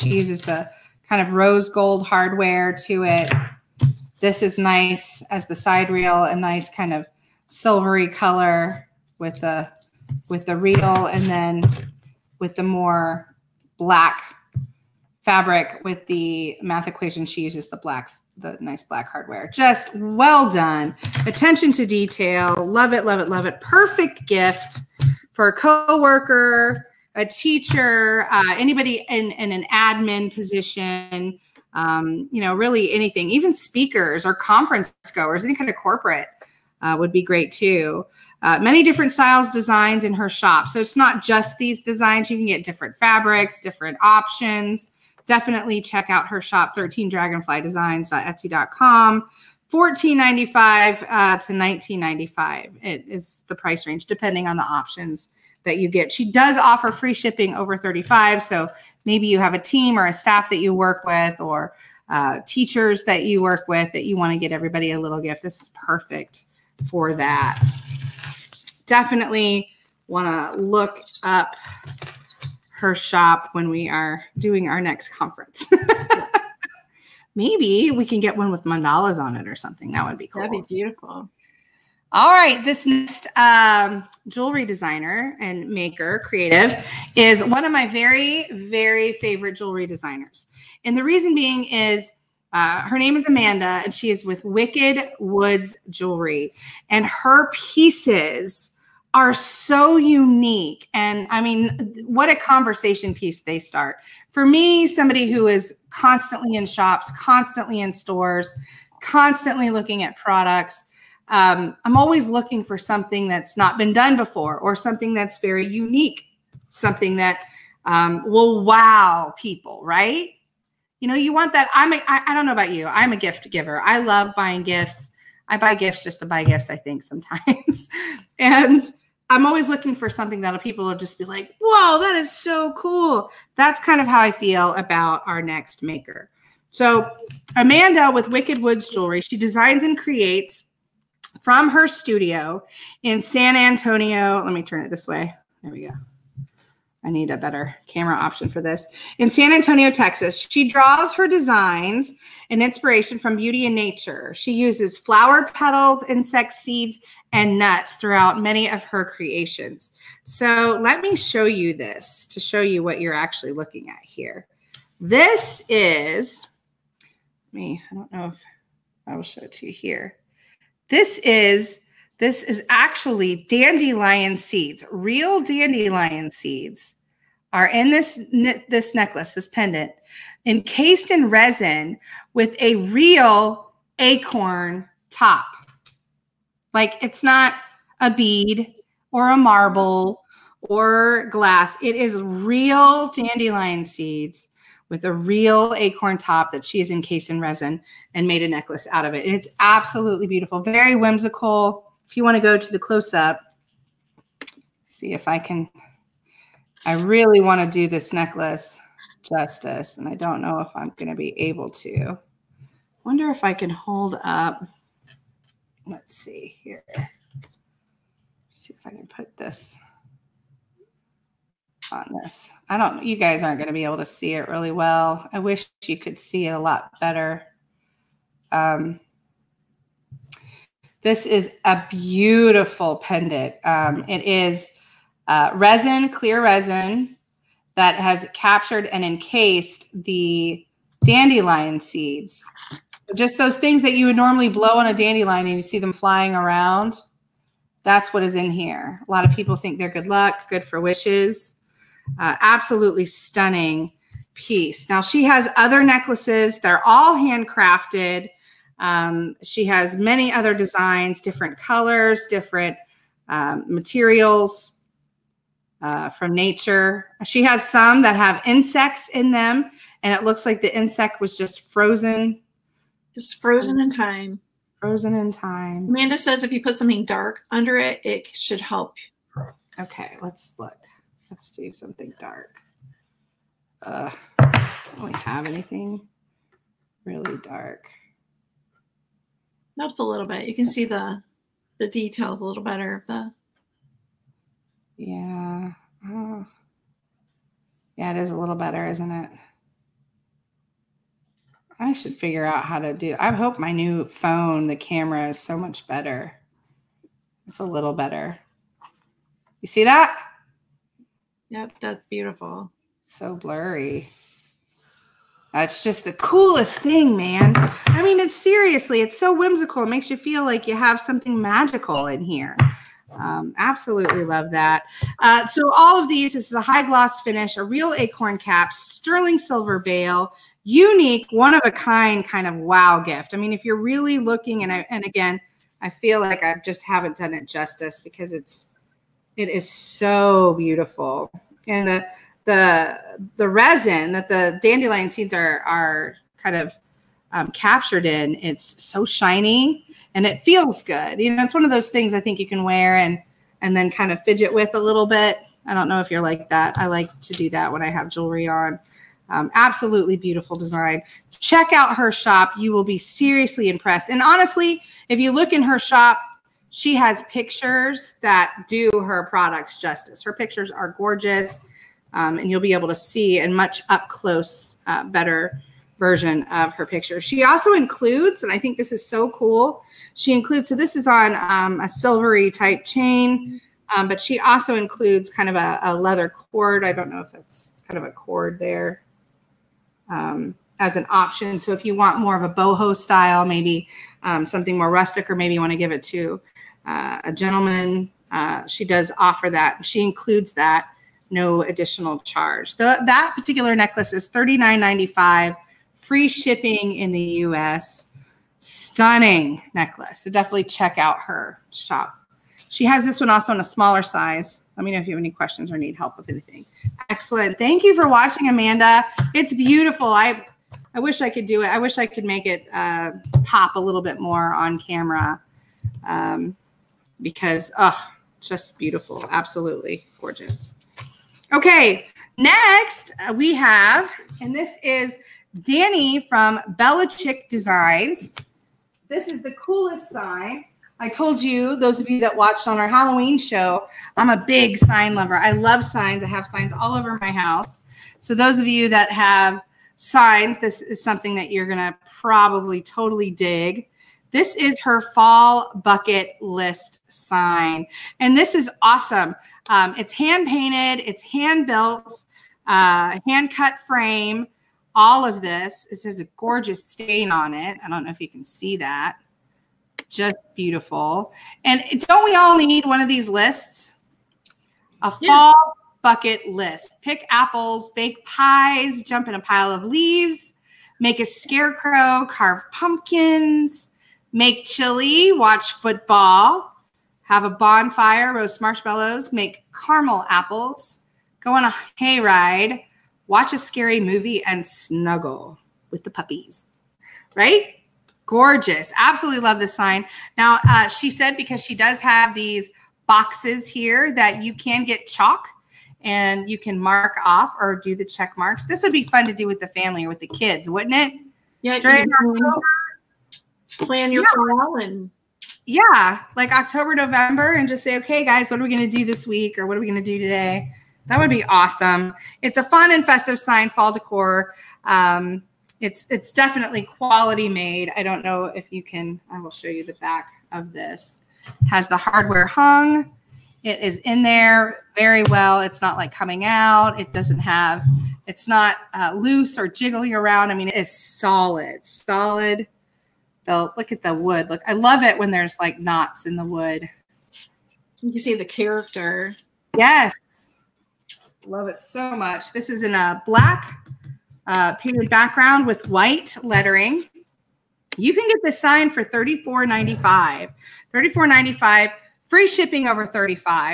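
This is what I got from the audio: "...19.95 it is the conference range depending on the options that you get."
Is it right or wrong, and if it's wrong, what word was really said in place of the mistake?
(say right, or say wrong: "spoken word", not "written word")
wrong: "price", not "conference".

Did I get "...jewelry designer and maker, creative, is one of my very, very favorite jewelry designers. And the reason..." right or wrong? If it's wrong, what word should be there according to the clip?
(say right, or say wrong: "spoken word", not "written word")
right.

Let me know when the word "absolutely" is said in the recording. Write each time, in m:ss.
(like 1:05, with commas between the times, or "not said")
3:19, 4:12, 5:23, 5:59, 7:09, 8:18.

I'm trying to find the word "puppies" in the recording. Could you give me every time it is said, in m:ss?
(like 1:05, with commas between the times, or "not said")
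8:16.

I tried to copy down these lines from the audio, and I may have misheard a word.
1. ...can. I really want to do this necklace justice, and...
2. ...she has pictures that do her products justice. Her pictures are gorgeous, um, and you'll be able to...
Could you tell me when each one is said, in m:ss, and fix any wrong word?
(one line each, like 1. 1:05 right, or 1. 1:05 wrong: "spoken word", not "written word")
1. 3:25 right
2. 6:06 right.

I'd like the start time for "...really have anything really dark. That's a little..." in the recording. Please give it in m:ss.
4:44.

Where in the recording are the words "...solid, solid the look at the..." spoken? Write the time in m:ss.
9:01.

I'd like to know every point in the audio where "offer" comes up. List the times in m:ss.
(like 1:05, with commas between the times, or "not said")
0:56, 6:39.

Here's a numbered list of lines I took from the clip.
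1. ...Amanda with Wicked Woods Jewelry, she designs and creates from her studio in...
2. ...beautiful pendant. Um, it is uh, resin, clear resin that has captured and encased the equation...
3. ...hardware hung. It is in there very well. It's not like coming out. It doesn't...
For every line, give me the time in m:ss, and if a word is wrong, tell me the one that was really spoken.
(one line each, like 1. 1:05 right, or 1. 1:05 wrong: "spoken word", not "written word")
1. 2:17 right
2. 3:51 wrong: "dandelion", not "equation"
3. 8:51 right.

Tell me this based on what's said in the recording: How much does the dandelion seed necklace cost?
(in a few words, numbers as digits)
$39.95.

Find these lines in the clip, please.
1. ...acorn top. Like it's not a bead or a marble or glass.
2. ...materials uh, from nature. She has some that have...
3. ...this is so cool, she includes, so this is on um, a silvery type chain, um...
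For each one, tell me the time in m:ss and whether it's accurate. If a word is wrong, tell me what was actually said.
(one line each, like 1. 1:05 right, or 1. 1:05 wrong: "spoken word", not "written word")
1. 3:03 right
2. 4:23 right
3. 6:18 right.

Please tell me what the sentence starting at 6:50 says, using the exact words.
So definitely check out her shop.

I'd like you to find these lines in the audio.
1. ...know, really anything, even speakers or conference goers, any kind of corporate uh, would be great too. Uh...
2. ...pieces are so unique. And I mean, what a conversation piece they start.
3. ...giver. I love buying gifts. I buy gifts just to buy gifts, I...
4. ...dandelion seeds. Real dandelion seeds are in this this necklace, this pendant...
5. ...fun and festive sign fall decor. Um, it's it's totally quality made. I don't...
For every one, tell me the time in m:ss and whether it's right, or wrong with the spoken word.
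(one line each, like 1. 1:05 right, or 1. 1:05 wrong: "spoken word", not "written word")
1. 0:32 right
2. 1:37 right
3. 2:03 right
4. 2:53 right
5. 8:42 wrong: "definitely", not "totally".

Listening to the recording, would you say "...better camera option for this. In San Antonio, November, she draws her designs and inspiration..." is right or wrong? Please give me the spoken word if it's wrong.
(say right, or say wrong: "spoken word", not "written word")
wrong: "Texas", not "November".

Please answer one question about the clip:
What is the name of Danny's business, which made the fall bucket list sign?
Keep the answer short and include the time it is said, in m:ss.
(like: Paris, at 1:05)
Bella Chick Designs, at 7:16.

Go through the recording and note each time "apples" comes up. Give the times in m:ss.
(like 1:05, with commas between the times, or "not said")
7:57, 8:10.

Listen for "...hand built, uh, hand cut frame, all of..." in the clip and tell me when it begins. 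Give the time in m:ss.
7:41.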